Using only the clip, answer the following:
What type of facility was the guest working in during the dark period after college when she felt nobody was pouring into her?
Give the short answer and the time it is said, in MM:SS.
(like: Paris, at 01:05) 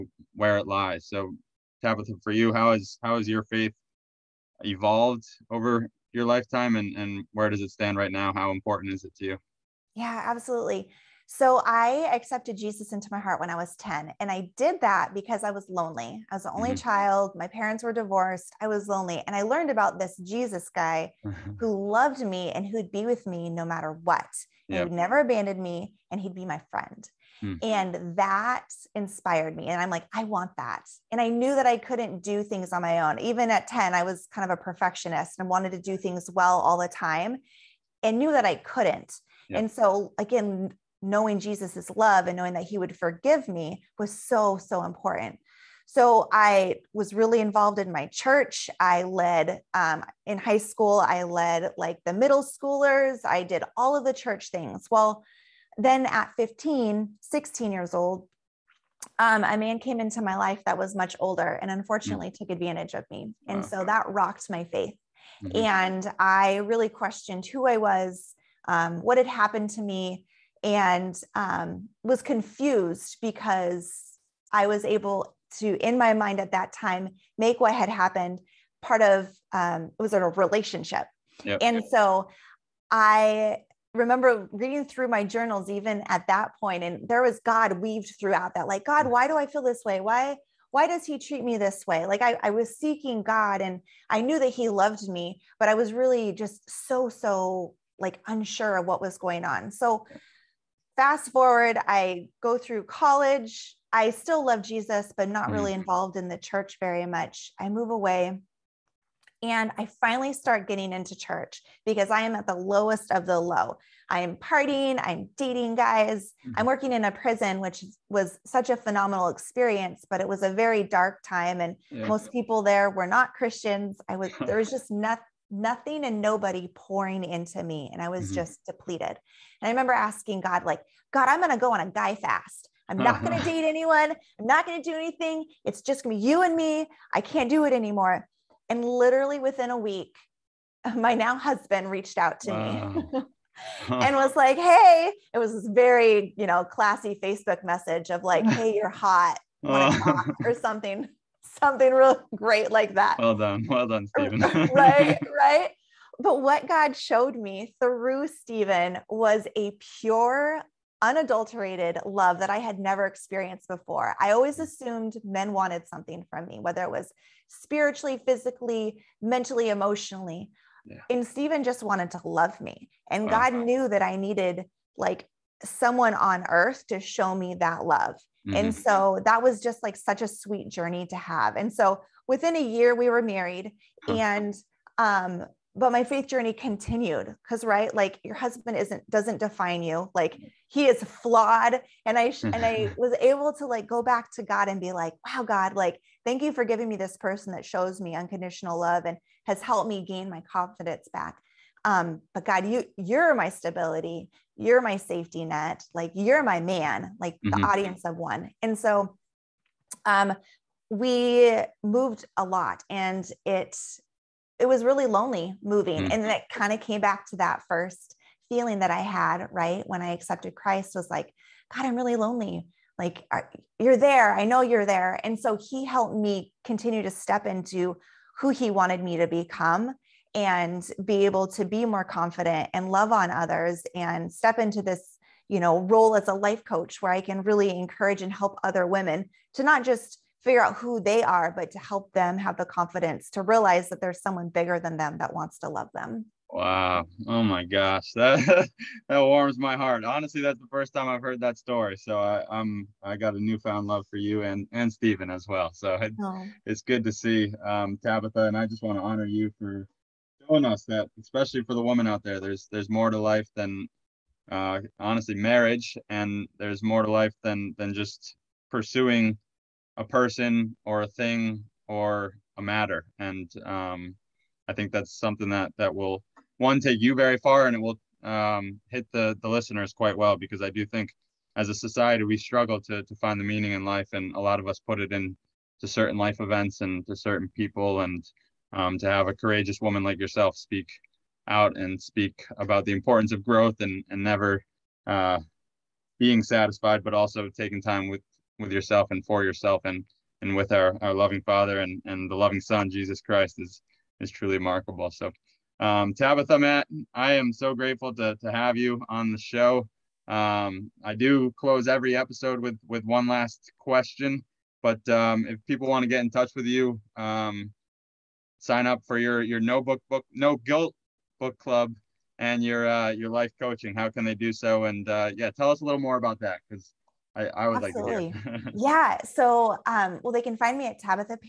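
Prison, at 01:57.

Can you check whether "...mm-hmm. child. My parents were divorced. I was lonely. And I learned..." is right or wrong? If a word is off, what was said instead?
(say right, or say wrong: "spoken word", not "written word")
right.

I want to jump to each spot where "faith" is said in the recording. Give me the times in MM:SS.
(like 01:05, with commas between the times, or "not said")
00:03, 01:04, 03:06.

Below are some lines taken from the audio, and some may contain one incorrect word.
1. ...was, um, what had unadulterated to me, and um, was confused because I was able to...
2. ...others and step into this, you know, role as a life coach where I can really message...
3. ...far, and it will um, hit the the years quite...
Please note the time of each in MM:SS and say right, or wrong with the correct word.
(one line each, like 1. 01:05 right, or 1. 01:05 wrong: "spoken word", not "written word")
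1. 01:07 wrong: "happened", not "unadulterated"
2. 03:53 wrong: "encourage", not "message"
3. 04:37 wrong: "listeners", not "years".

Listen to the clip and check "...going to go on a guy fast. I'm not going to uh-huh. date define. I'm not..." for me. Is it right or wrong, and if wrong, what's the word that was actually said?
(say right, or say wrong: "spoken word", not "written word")
wrong: "anyone", not "define".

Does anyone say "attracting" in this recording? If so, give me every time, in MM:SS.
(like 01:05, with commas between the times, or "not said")
not said.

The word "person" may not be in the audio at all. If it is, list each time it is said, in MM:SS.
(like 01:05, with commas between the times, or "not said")
03:17, 04:30.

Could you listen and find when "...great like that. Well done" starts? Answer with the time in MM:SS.
02:32.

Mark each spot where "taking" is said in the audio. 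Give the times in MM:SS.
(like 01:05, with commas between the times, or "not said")
04:57.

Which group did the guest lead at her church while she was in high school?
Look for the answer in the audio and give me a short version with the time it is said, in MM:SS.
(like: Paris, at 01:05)
The middle schoolers, at 00:52.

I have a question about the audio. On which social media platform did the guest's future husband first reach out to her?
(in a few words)
Facebook.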